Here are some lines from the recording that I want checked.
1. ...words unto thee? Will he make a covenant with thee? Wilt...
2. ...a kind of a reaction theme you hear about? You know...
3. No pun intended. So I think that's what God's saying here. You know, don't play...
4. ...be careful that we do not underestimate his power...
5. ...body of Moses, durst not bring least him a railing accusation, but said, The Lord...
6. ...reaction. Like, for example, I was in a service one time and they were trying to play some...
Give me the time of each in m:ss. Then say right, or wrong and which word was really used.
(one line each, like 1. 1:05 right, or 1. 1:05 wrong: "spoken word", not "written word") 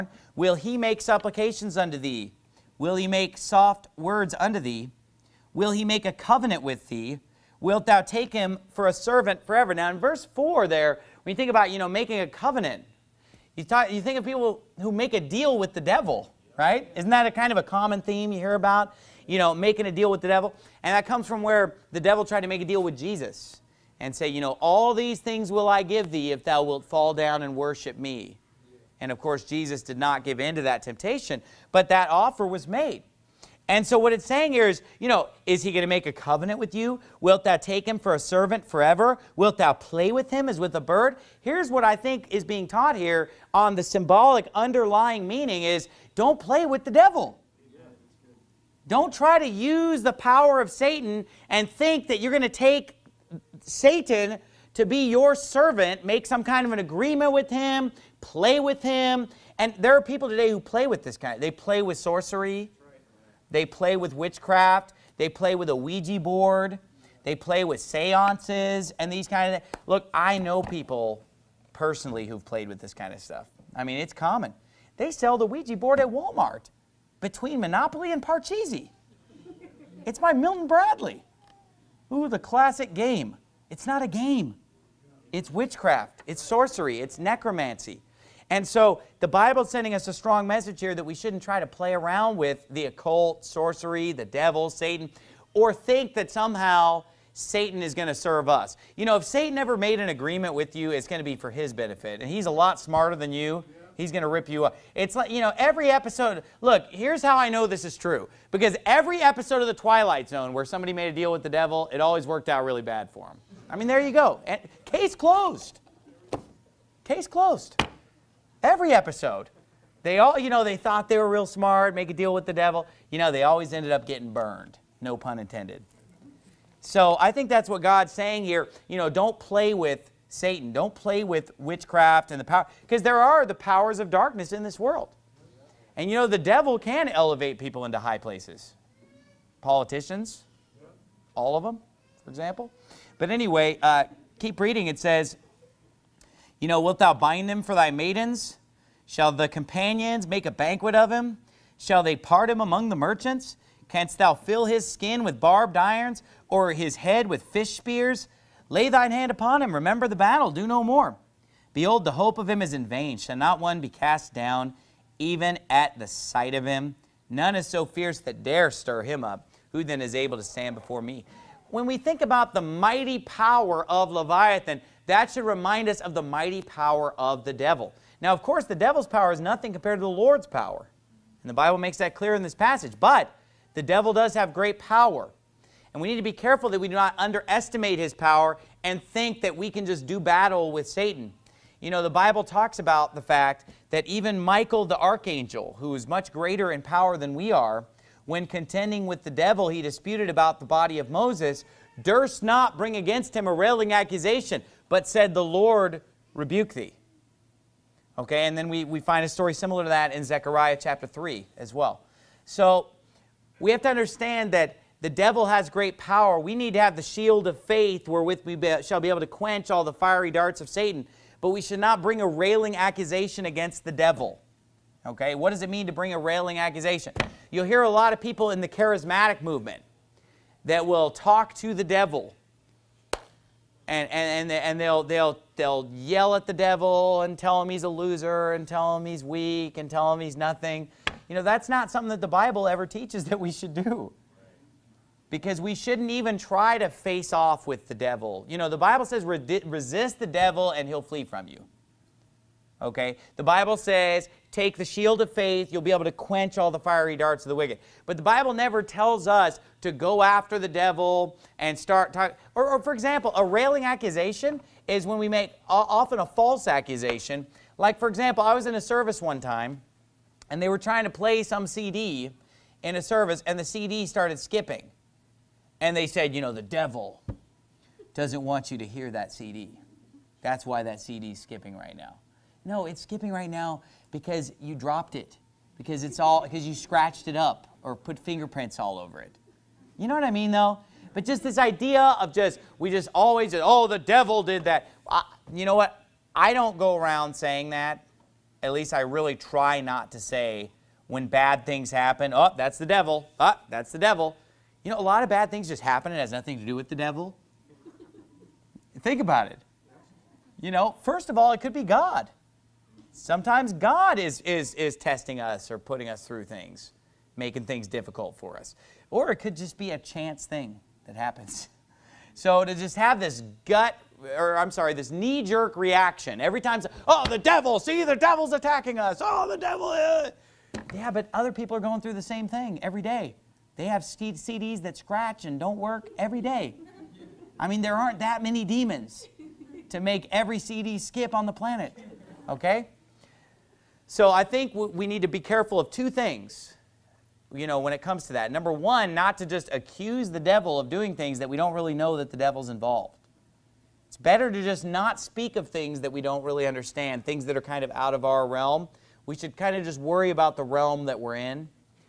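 1. 0:03 right
2. 0:17 wrong: "common", not "reaction"
3. 2:05 right
4. 3:06 right
5. 3:20 wrong: "against", not "least"
6. 4:26 wrong: "accusation", not "reaction".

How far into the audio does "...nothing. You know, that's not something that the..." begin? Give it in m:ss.
4:00.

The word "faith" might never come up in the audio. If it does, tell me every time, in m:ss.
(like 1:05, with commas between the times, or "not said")
3:37, 4:15.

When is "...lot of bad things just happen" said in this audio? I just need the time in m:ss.
5:05.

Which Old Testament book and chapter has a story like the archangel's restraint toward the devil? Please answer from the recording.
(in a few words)
Zechariah chapter 3.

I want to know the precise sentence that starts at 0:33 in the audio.
And so what it's saying here is, you know, is he going to make a covenant with you?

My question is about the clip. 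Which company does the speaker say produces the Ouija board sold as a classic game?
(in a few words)
Milton Bradley.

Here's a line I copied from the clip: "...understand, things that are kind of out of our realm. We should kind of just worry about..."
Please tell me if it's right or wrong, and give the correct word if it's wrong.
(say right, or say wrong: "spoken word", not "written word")
right.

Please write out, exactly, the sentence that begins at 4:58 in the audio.
At least I really try not to say when bad things happen.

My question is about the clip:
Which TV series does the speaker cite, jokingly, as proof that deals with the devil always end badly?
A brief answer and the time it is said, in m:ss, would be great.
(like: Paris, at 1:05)
The Twilight Zone, at 1:49.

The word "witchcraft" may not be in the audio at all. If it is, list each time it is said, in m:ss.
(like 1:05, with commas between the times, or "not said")
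1:04, 1:25, 2:11.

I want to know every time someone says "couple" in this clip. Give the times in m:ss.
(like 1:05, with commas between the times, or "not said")
not said.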